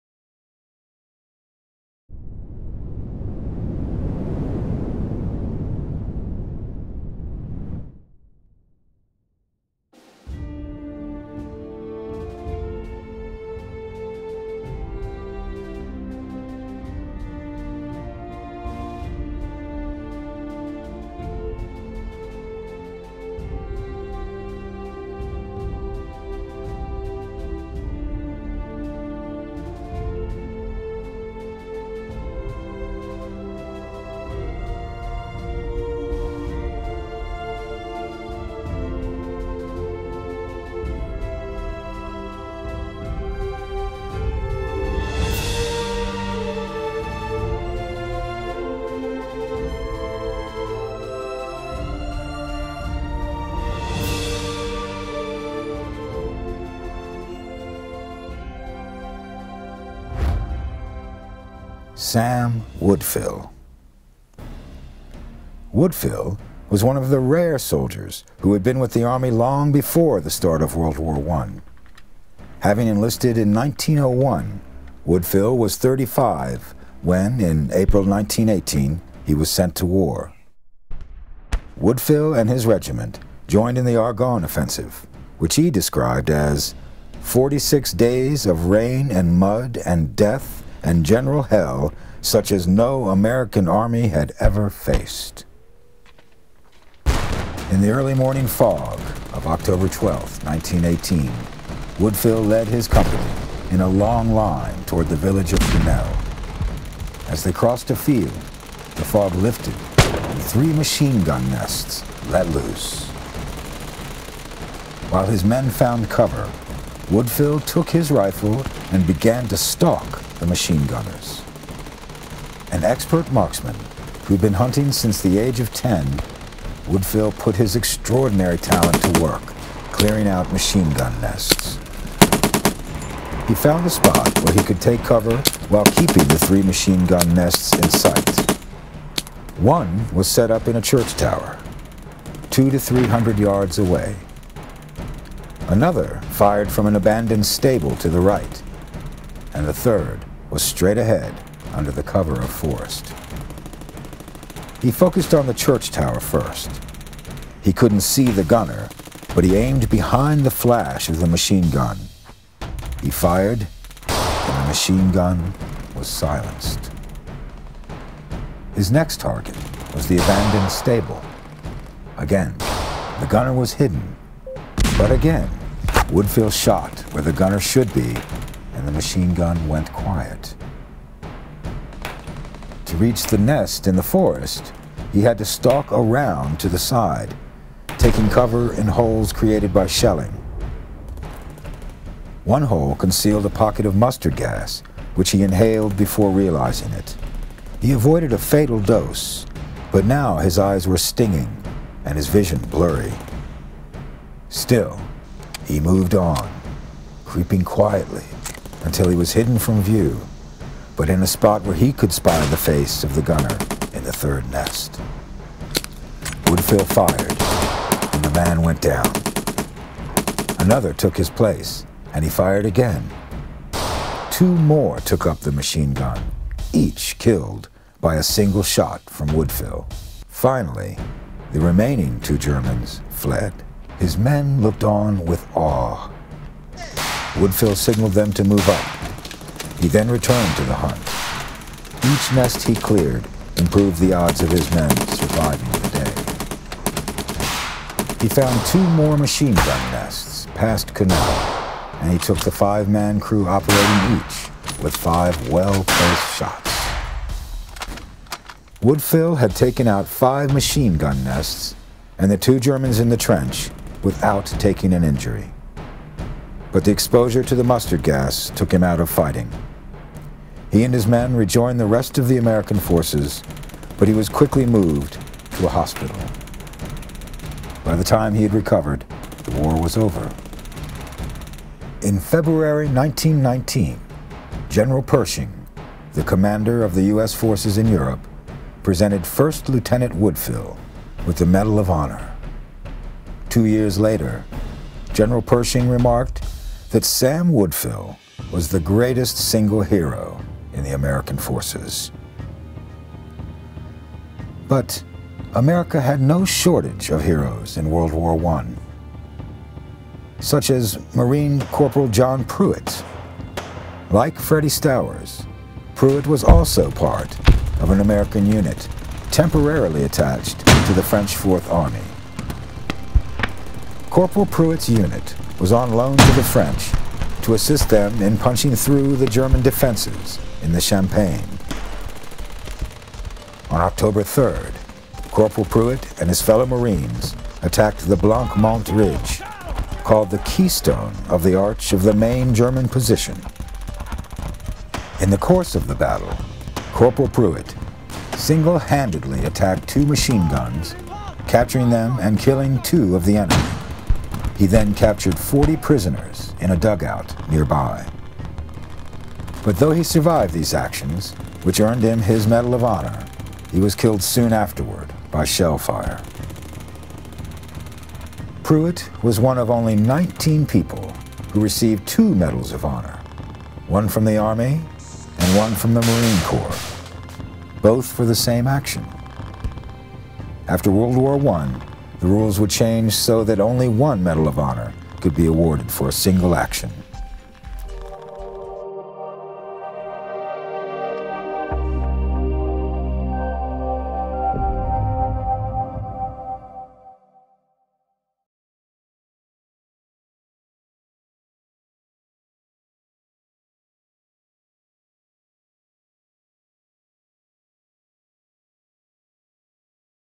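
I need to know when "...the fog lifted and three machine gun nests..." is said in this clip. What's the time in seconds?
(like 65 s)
108 s.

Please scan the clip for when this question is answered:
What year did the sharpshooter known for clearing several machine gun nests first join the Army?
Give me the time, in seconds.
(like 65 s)
73 s.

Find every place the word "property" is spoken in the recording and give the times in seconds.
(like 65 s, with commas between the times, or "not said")
not said.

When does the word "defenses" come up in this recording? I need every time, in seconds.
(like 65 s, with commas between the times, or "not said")
329 s.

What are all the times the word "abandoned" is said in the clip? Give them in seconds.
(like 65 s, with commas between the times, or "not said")
146 s, 170 s.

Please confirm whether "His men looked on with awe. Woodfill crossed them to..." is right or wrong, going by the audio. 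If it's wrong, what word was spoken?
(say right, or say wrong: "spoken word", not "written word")
wrong: "signaled", not "crossed".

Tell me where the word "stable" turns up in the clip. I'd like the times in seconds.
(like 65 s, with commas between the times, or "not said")
147 s, 170 s.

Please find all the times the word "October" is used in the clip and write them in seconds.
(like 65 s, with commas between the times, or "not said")
99 s, 333 s.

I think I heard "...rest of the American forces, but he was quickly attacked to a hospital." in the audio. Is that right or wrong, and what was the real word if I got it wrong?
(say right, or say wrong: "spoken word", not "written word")
wrong: "moved", not "attacked".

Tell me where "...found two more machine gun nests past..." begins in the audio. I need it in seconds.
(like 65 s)
248 s.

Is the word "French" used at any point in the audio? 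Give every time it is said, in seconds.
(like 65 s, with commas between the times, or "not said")
321 s, 326 s.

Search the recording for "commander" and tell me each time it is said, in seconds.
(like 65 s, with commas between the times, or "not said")
286 s.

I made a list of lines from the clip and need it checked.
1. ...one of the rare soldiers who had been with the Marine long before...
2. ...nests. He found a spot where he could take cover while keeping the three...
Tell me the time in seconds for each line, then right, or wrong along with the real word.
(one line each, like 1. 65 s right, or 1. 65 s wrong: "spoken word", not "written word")
1. 66 s wrong: "Army", not "Marine"
2. 131 s right.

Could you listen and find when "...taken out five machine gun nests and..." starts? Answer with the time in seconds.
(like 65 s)
259 s.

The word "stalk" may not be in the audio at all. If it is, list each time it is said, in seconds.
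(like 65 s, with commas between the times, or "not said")
119 s, 185 s.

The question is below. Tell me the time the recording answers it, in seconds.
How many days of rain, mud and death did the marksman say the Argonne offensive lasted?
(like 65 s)
87 s.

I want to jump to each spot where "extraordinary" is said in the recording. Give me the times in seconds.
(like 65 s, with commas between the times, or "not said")
127 s.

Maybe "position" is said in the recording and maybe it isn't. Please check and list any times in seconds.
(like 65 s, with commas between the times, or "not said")
342 s.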